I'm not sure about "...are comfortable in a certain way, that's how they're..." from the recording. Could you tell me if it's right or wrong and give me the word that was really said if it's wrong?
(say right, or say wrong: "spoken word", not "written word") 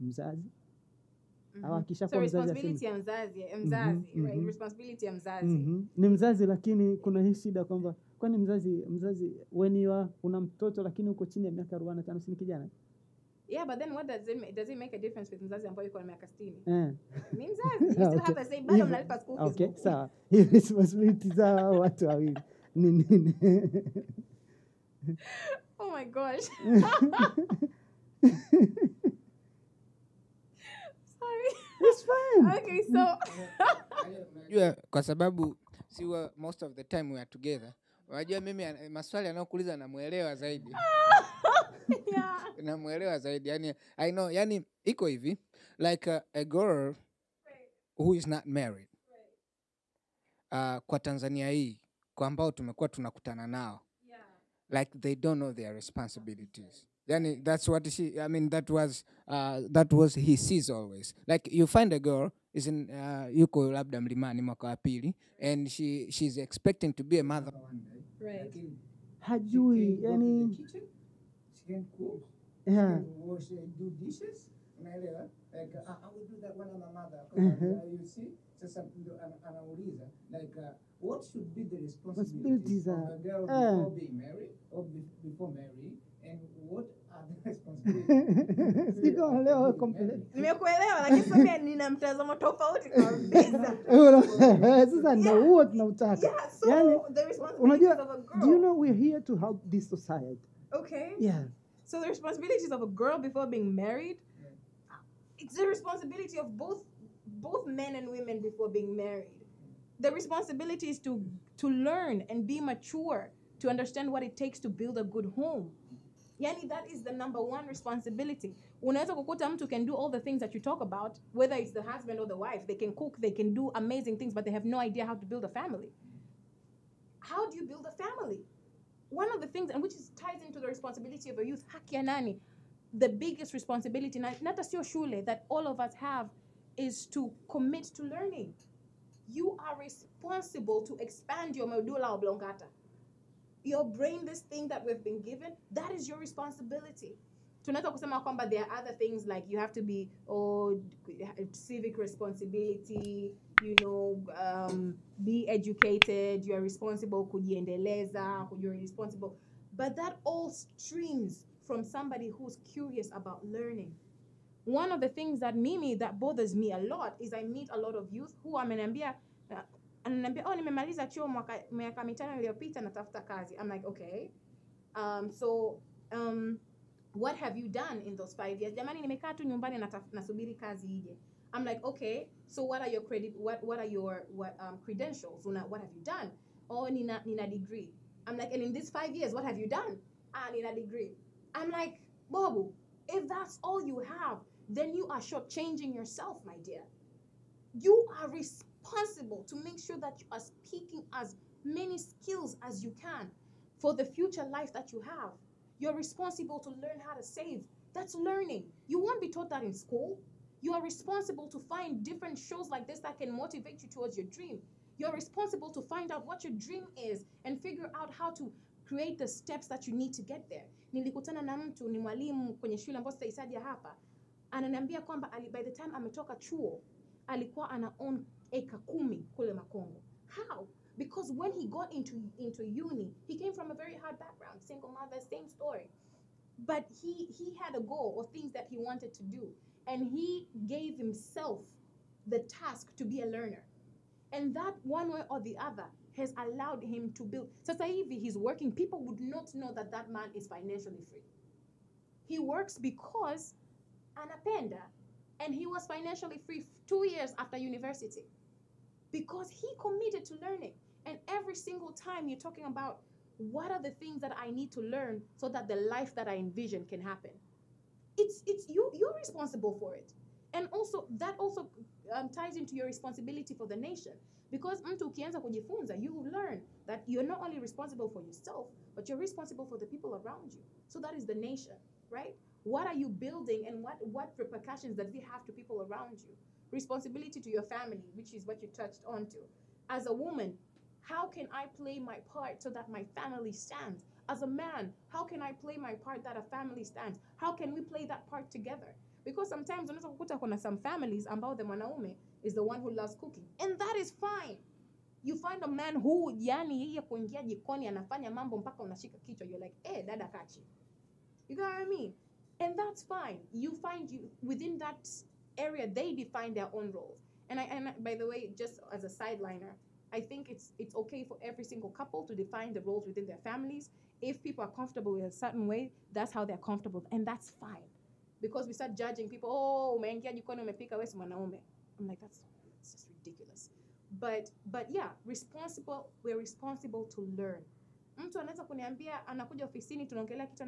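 right.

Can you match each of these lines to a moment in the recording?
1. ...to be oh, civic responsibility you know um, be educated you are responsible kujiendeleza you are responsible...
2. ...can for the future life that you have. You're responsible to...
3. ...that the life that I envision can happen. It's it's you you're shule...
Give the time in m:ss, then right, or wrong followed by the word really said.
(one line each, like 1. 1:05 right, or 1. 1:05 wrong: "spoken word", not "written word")
1. 2:29 right
2. 3:23 right
3. 4:25 wrong: "responsible", not "shule".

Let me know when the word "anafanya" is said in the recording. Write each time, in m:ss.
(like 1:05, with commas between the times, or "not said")
5:07.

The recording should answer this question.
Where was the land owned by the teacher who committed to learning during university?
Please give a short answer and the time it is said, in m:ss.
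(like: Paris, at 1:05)
Makongo, at 3:49.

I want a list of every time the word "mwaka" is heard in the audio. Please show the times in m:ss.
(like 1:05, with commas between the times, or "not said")
1:04, 2:51.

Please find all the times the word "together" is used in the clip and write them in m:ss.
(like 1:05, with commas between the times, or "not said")
0:37, 4:58.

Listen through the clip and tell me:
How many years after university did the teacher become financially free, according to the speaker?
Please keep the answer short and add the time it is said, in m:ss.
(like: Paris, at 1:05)
2, at 4:16.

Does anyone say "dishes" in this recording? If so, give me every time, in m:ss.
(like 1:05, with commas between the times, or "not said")
1:14.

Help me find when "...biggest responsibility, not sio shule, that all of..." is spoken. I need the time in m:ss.
2:13.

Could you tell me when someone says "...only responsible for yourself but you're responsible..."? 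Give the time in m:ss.
4:37.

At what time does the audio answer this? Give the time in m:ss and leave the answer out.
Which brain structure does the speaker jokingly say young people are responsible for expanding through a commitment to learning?
2:21.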